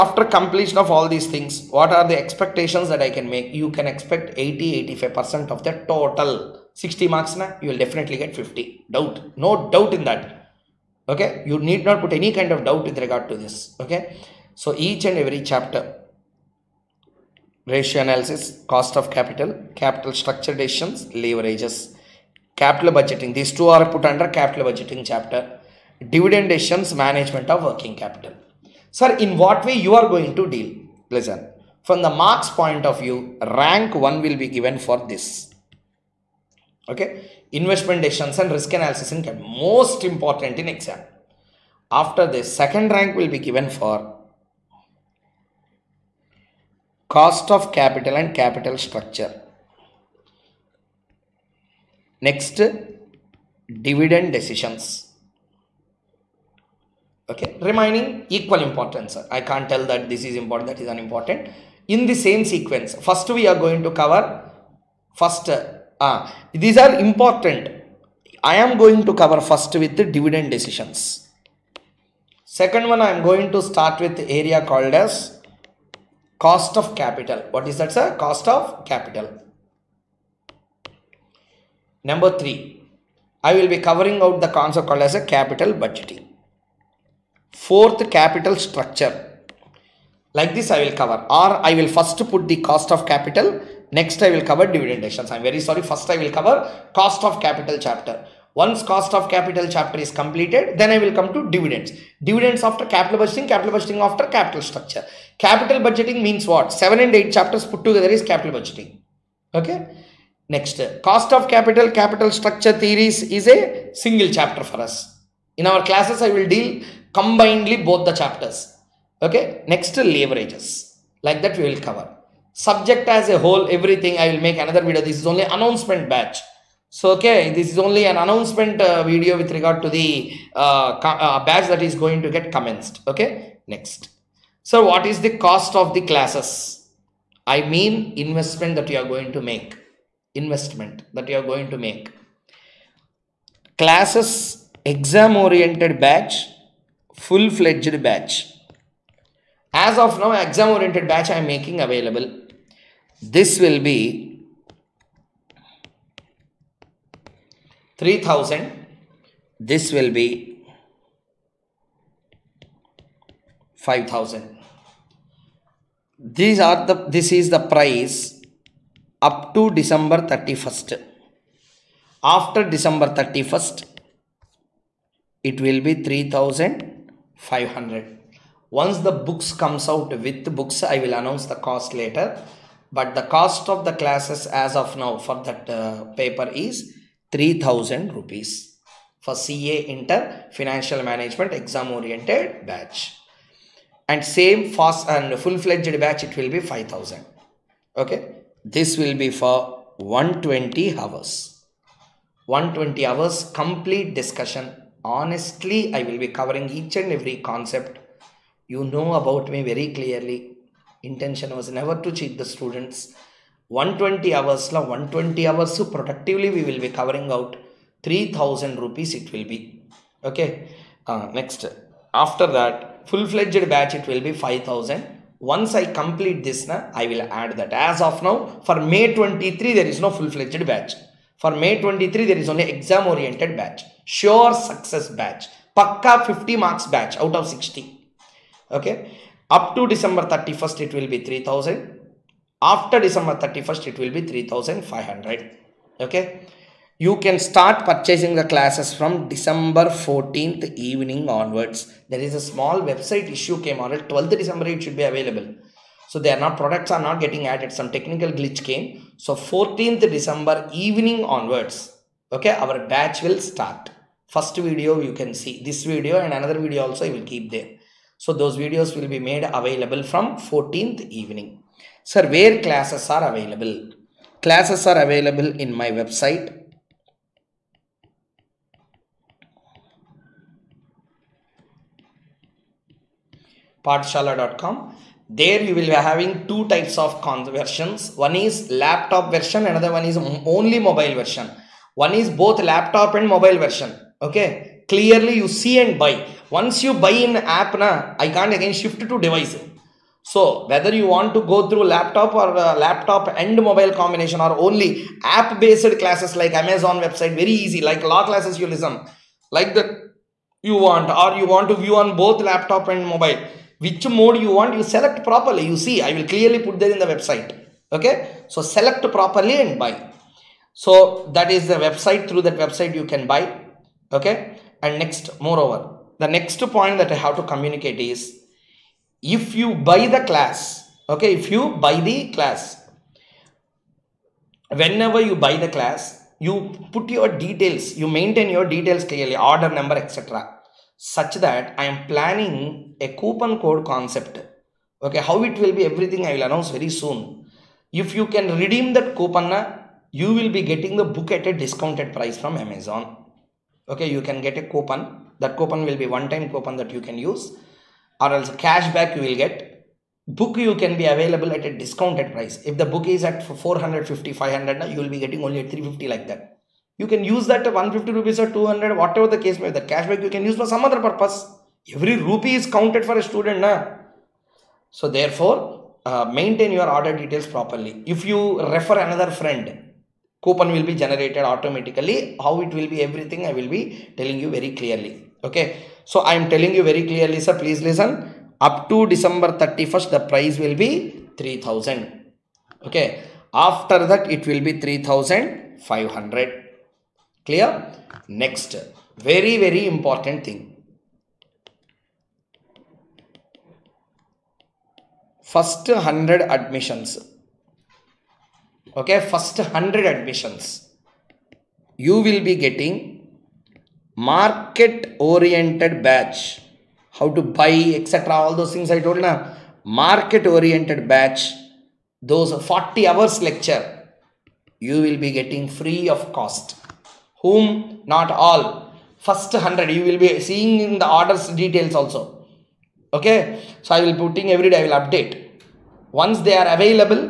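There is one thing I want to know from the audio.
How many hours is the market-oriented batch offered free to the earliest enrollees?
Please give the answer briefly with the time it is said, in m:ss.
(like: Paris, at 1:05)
40 hours, at 7:02.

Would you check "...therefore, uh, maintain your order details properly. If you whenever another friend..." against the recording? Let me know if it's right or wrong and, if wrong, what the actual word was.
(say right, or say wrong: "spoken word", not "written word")
wrong: "refer", not "whenever".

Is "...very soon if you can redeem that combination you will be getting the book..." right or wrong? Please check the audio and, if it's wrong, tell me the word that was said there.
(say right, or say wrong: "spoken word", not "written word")
wrong: "coupon", not "combination".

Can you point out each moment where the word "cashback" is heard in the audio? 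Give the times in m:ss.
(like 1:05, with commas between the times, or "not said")
5:58, 6:09.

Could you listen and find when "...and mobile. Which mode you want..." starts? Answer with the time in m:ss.
5:12.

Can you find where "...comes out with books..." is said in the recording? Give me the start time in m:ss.
2:59.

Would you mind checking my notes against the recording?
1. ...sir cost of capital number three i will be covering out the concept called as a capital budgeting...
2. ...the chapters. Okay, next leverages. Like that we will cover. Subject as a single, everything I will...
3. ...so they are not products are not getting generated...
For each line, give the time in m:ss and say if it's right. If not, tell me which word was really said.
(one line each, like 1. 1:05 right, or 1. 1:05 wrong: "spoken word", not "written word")
1. 1:17 right
2. 1:58 wrong: "whole", not "single"
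3. 4:16 wrong: "added", not "generated".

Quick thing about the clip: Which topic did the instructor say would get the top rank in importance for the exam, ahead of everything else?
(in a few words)
Investment decisions and risk analysis.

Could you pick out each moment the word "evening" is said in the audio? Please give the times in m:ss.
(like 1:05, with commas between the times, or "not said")
4:10, 4:20, 4:31.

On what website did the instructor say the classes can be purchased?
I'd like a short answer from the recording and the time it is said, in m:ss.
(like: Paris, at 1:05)
paathashalaw.com, at 4:43.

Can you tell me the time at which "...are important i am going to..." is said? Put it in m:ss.
1:06.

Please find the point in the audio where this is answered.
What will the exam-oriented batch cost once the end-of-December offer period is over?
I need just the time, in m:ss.
4:02.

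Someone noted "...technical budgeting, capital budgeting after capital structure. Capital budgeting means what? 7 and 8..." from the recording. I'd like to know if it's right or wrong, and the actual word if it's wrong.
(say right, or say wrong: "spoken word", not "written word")
wrong: "capital", not "technical".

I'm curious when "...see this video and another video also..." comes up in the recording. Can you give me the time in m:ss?
4:25.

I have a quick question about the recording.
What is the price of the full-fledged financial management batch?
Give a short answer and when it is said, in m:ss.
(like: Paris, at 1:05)
5000 rupees, at 3:16.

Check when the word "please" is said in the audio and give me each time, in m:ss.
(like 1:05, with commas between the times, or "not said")
6:27.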